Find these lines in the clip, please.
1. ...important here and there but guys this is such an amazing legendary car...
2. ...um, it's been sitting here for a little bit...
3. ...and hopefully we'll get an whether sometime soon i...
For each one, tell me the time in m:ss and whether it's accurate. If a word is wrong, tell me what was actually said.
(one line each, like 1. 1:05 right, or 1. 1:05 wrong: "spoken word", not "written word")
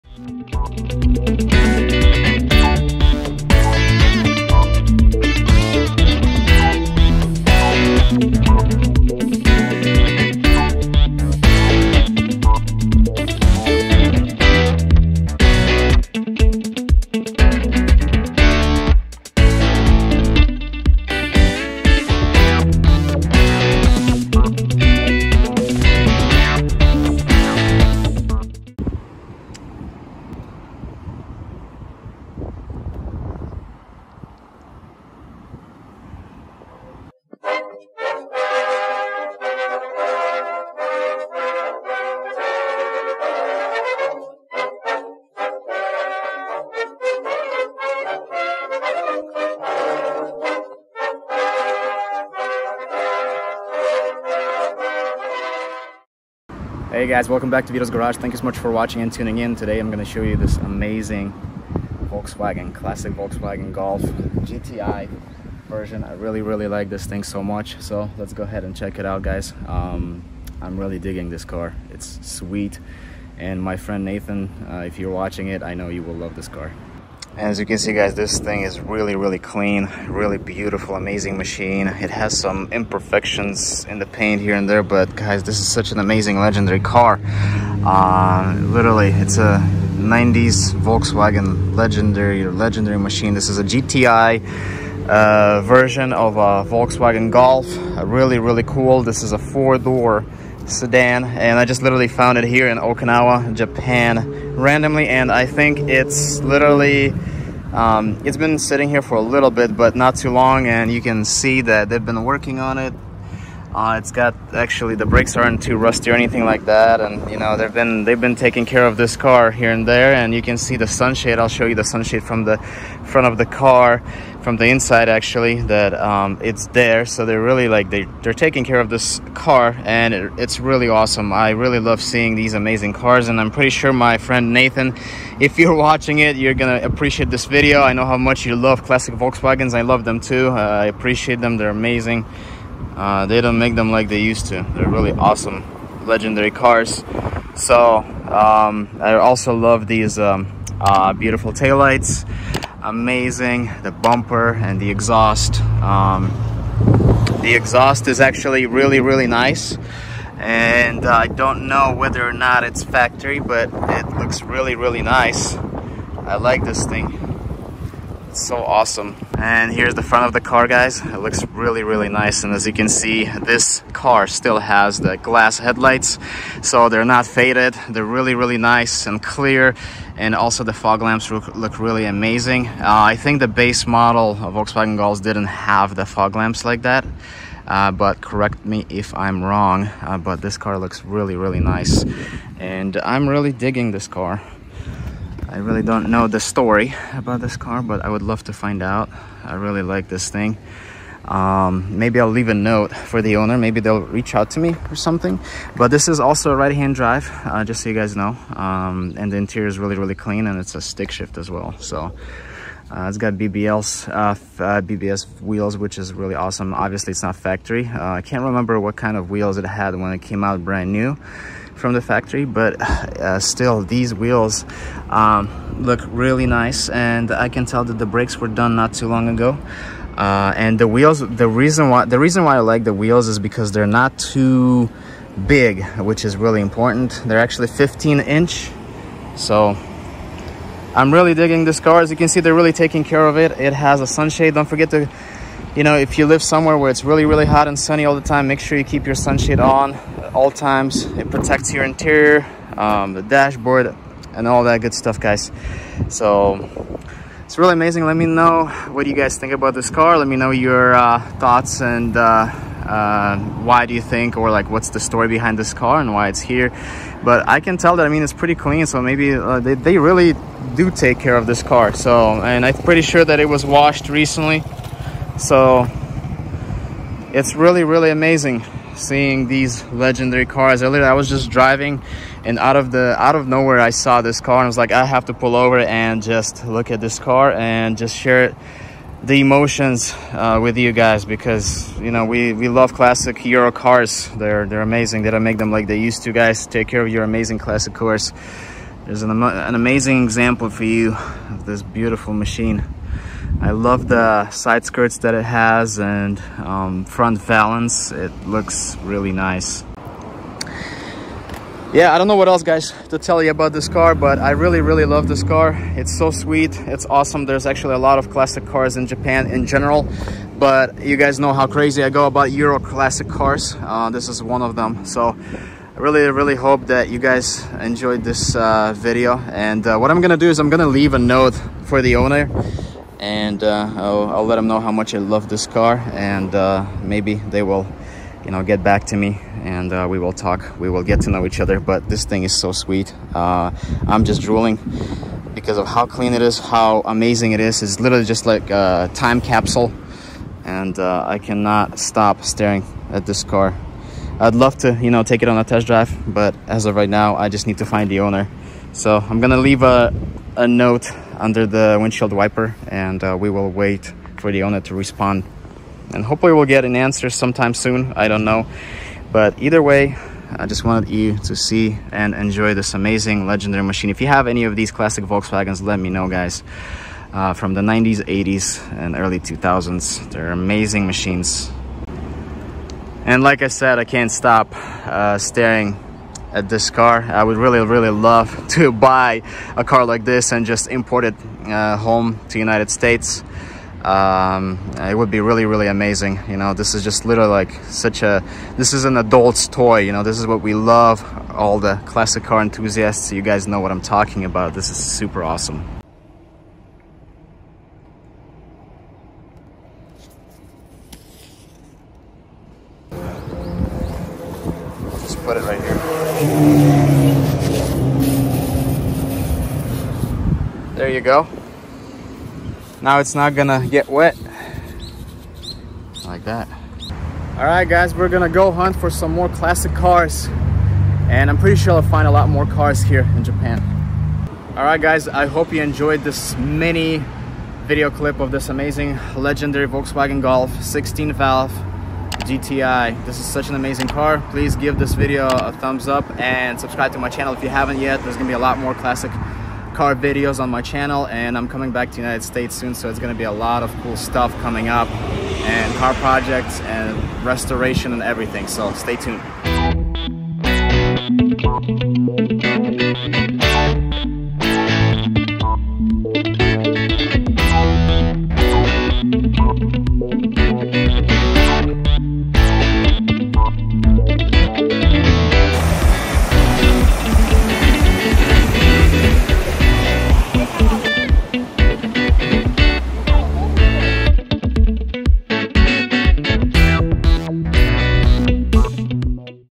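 1. 1:24 wrong: "paint", not "important"
2. 1:47 right
3. 6:06 wrong: "answer", not "whether".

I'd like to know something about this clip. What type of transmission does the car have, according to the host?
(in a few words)
Stick shift.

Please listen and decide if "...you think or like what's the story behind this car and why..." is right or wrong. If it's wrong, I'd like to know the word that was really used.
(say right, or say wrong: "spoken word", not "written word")
right.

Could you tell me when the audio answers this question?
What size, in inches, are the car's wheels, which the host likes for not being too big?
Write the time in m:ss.
3:57.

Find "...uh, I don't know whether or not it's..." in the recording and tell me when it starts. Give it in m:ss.
2:41.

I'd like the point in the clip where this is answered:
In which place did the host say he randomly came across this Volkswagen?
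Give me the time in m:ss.
1:42.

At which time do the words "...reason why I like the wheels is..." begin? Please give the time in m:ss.
3:52.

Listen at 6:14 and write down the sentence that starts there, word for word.
If you have any of these classic Volkswagens, let me know, guys.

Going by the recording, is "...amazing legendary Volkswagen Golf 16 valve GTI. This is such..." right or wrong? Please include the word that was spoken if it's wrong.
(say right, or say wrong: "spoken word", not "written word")
right.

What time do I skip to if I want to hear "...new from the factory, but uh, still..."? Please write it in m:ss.
3:40.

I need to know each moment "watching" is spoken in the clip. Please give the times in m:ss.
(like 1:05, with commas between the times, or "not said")
0:58, 1:15, 2:15.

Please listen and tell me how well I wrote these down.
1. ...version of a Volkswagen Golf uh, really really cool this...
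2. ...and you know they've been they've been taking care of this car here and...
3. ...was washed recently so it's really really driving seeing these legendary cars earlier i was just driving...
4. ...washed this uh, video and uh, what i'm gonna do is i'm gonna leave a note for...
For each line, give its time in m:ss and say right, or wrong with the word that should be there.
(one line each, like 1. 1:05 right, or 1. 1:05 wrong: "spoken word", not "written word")
1. 1:35 right
2. 1:56 right
3. 4:33 wrong: "amazing", not "driving"
4. 5:27 wrong: "enjoyed", not "washed".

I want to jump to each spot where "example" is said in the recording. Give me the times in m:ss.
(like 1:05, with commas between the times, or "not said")
5:00.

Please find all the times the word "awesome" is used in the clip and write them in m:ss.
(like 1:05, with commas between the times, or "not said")
2:10, 2:25, 2:48, 3:36, 5:17, 6:45.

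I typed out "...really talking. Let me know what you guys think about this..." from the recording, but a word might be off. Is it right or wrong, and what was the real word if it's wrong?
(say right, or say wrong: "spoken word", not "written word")
wrong: "amazing", not "talking".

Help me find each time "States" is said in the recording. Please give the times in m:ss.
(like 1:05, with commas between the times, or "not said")
6:32, 7:32.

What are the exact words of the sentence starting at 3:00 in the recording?
And also the fog lamps look, look really amazing.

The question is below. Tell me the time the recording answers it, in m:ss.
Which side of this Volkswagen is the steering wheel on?
3:26.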